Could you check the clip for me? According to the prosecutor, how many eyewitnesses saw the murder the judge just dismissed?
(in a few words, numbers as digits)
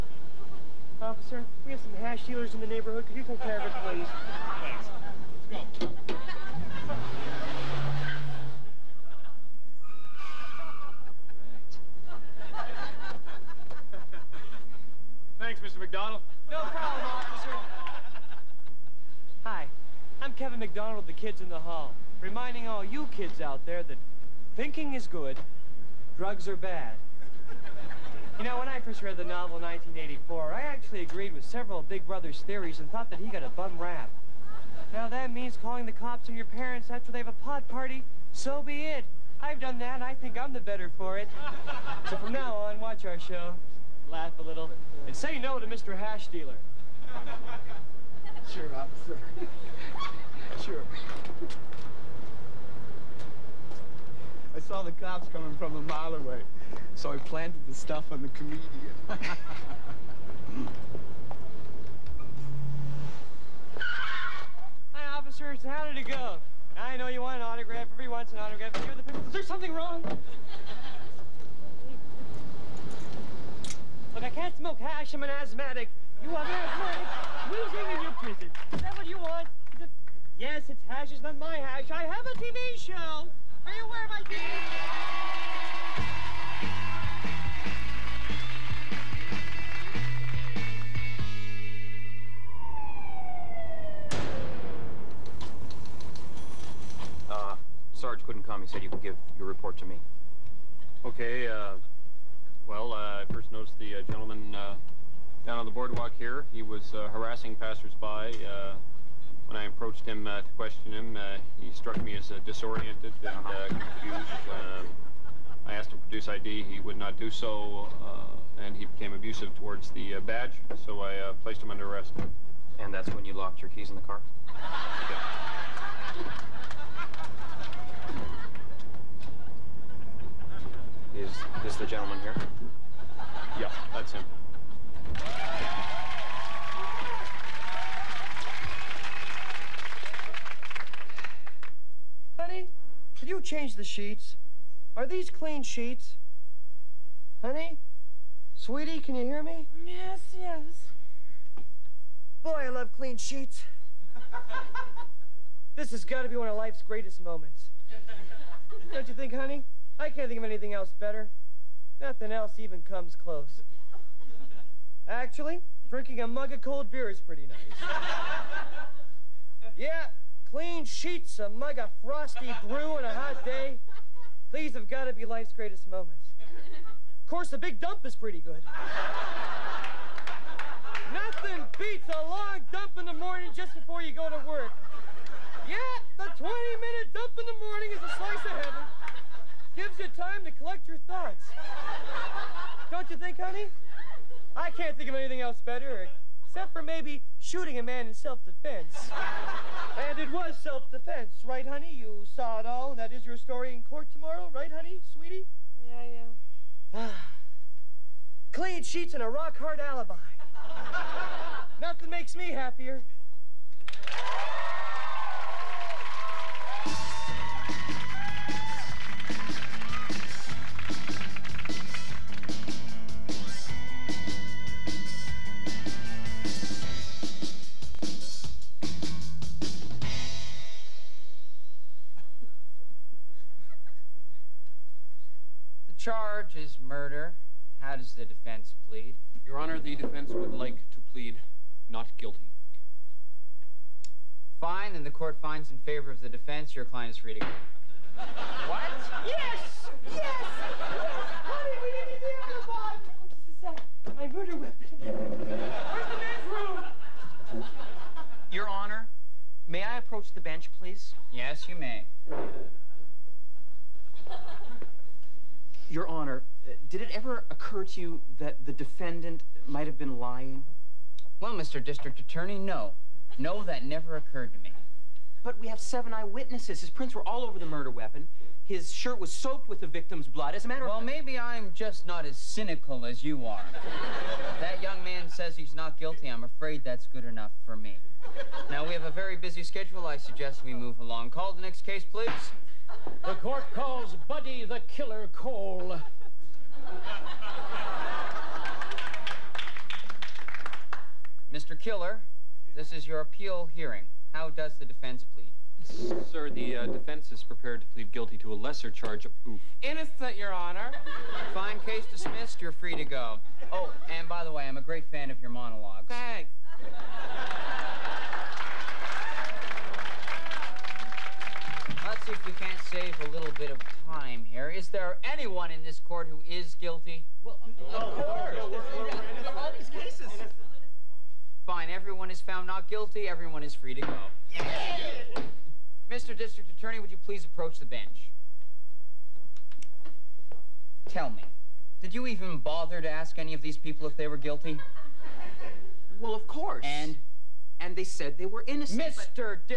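7.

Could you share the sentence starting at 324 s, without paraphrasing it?
Is there anyone in this court who is guilty?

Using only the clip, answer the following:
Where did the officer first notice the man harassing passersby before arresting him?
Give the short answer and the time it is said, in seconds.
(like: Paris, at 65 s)
The boardwalk, at 105 s.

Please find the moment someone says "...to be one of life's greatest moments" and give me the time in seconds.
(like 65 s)
156 s.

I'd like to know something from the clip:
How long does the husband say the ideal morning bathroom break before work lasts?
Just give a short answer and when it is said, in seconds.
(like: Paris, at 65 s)
20 minutes, at 186 s.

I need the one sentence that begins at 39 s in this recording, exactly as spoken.
I've done that, and I think I'm the better for it.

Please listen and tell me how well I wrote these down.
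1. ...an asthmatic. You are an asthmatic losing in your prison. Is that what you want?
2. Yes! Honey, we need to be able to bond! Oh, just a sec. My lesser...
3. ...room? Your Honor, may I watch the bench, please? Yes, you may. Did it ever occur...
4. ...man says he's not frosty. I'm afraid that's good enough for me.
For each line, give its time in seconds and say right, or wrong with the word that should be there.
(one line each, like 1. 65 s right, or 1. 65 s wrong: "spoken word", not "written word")
1. 75 s right
2. 250 s wrong: "murder", not "lesser"
3. 257 s wrong: "approach", not "watch"
4. 285 s wrong: "guilty", not "frosty".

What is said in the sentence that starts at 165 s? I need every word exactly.
Actually, drinking a mug of cold beer is pretty nice.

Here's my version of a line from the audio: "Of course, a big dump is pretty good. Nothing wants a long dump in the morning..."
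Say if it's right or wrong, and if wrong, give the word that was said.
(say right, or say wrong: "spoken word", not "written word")
wrong: "beats", not "wants".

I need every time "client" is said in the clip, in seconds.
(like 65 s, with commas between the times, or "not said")
246 s.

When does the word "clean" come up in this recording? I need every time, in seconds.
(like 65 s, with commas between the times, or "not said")
145 s, 152 s, 170 s, 208 s.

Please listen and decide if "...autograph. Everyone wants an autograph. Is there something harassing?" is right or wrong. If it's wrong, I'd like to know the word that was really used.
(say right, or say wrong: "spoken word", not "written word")
wrong: "wrong", not "harassing".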